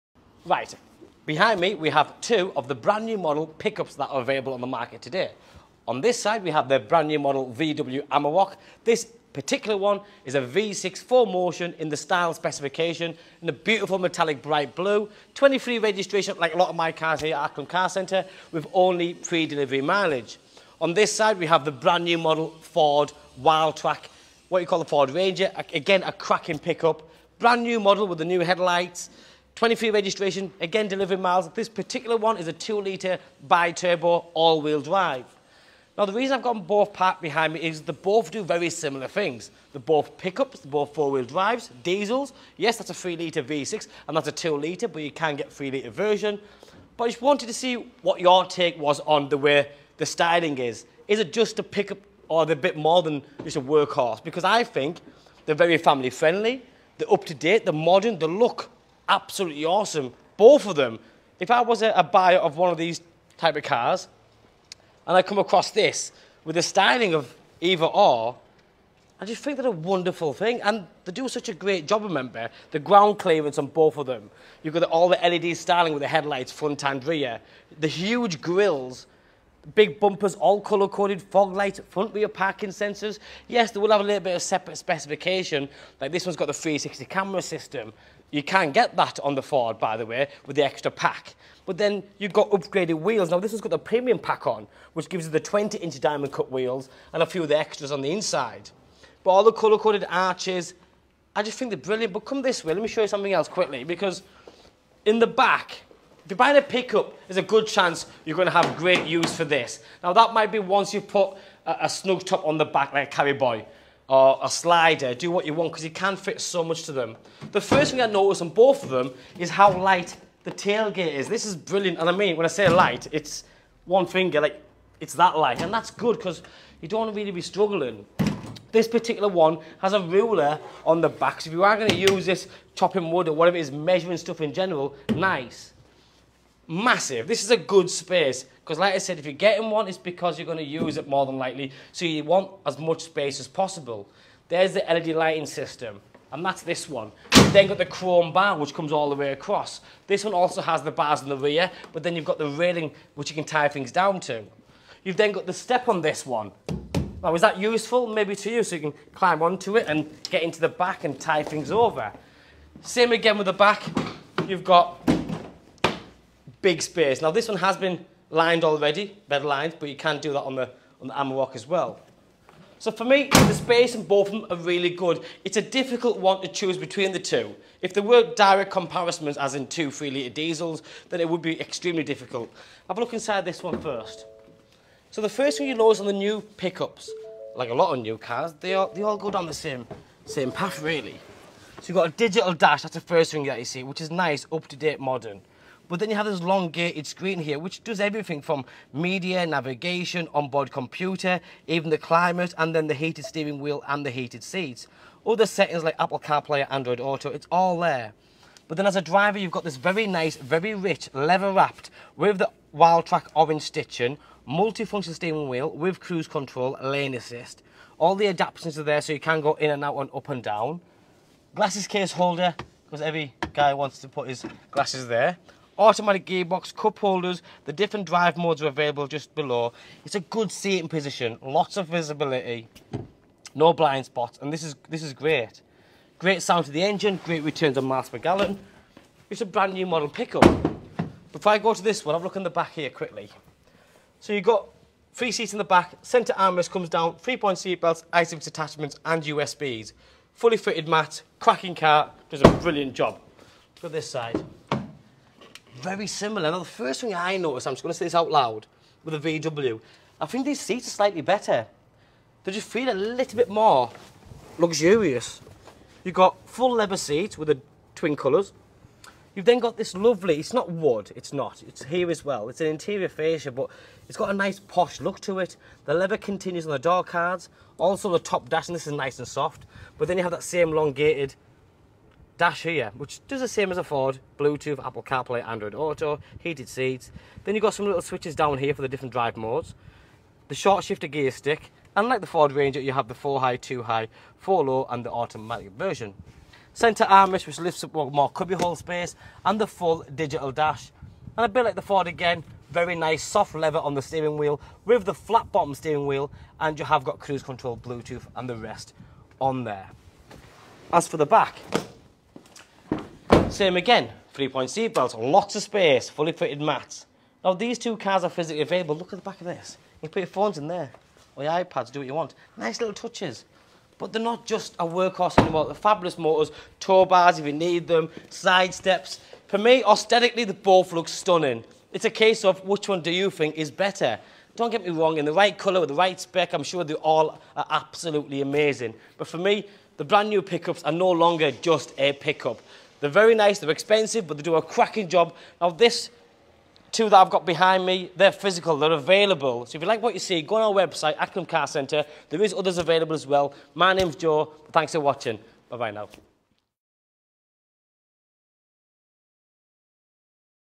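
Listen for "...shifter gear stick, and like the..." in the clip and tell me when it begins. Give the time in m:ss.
4:50.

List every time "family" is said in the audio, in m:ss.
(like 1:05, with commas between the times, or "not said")
0:55.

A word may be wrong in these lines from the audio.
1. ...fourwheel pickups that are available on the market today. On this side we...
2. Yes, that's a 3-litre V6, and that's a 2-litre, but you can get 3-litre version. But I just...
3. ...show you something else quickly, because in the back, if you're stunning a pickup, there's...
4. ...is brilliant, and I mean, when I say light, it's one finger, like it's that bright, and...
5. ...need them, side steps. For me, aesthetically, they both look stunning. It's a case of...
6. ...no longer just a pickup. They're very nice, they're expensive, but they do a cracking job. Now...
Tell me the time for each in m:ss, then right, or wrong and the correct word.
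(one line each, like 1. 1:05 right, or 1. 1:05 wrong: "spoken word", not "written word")
1. 0:03 wrong: "model", not "fourwheel"
2. 0:42 right
3. 1:42 wrong: "buying", not "stunning"
4. 2:01 wrong: "light", not "bright"
5. 5:27 right
6. 5:40 right.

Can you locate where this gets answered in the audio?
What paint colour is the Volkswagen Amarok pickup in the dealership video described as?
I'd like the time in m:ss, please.
0:13.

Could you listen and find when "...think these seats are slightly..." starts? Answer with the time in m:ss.
4:20.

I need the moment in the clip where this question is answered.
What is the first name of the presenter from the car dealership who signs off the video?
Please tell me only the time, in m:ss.
5:54.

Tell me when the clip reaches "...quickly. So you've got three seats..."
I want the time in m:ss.
4:02.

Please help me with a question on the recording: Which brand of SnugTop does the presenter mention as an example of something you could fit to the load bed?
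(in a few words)
Carryboy.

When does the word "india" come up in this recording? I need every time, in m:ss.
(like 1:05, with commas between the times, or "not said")
not said.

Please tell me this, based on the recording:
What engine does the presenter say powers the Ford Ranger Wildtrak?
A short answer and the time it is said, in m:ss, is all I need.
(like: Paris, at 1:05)
2-litre bi-turbo, at 0:32.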